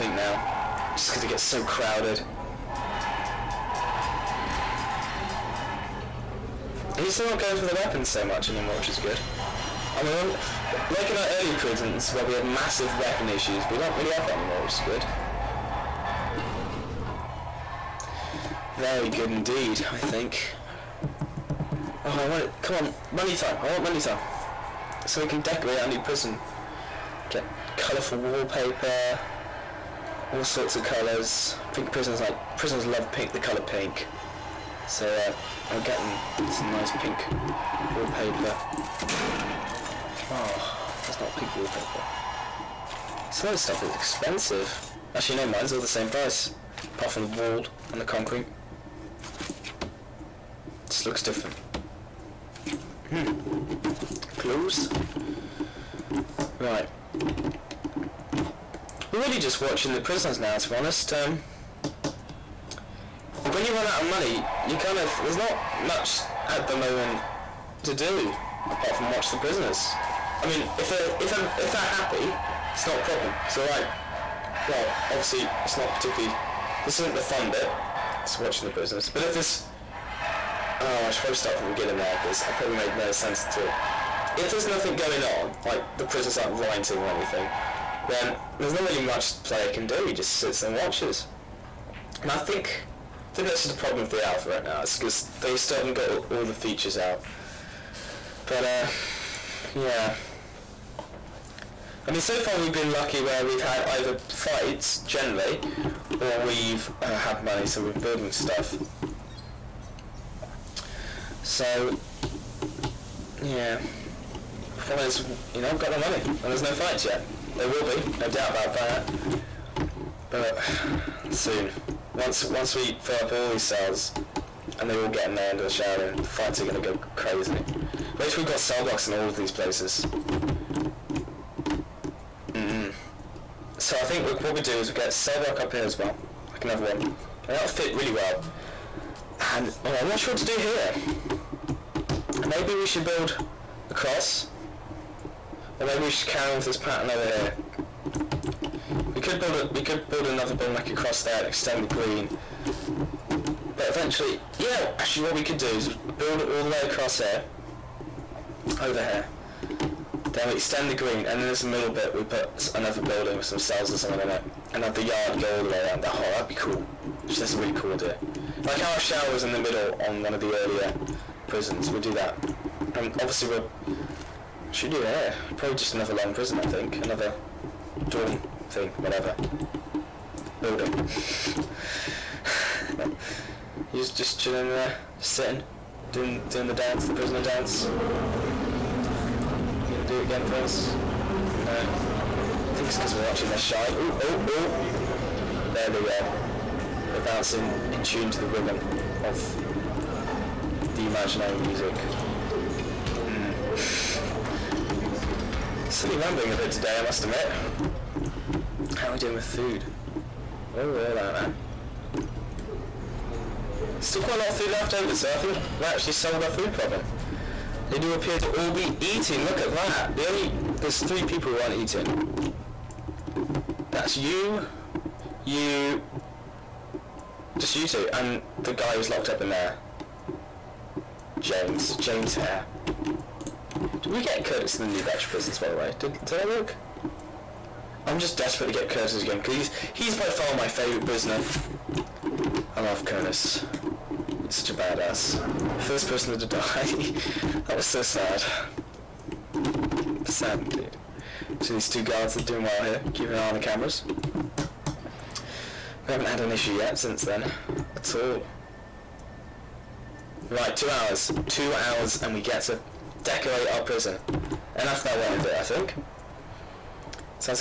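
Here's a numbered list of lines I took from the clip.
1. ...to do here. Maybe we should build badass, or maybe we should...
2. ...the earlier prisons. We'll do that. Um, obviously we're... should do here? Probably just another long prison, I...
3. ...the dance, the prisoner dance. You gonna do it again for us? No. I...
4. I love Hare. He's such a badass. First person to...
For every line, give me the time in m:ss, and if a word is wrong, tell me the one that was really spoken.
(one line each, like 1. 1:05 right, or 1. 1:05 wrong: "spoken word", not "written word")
1. 2:20 wrong: "across", not "badass"
2. 2:50 right
3. 3:06 right
4. 4:02 wrong: "Curtis", not "Hare".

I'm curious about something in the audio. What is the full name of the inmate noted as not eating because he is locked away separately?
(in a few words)
James Hare.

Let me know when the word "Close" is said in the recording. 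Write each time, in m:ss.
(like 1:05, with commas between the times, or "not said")
0:54.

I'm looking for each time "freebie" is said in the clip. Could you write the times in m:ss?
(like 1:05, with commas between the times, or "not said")
not said.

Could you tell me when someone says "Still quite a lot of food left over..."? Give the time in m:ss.
3:33.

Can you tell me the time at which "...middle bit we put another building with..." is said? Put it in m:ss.
2:41.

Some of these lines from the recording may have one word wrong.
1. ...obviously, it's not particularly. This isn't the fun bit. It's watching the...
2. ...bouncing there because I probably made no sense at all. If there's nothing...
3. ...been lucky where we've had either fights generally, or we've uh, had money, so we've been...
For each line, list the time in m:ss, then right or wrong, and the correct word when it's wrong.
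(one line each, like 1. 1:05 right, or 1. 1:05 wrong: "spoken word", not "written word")
1. 1:15 right
2. 1:21 wrong: "beginning", not "bouncing"
3. 1:42 right.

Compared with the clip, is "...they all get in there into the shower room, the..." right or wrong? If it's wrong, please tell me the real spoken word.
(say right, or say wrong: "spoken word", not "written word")
right.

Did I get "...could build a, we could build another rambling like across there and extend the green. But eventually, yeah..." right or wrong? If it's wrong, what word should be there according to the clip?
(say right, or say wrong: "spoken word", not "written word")
wrong: "building", not "rambling".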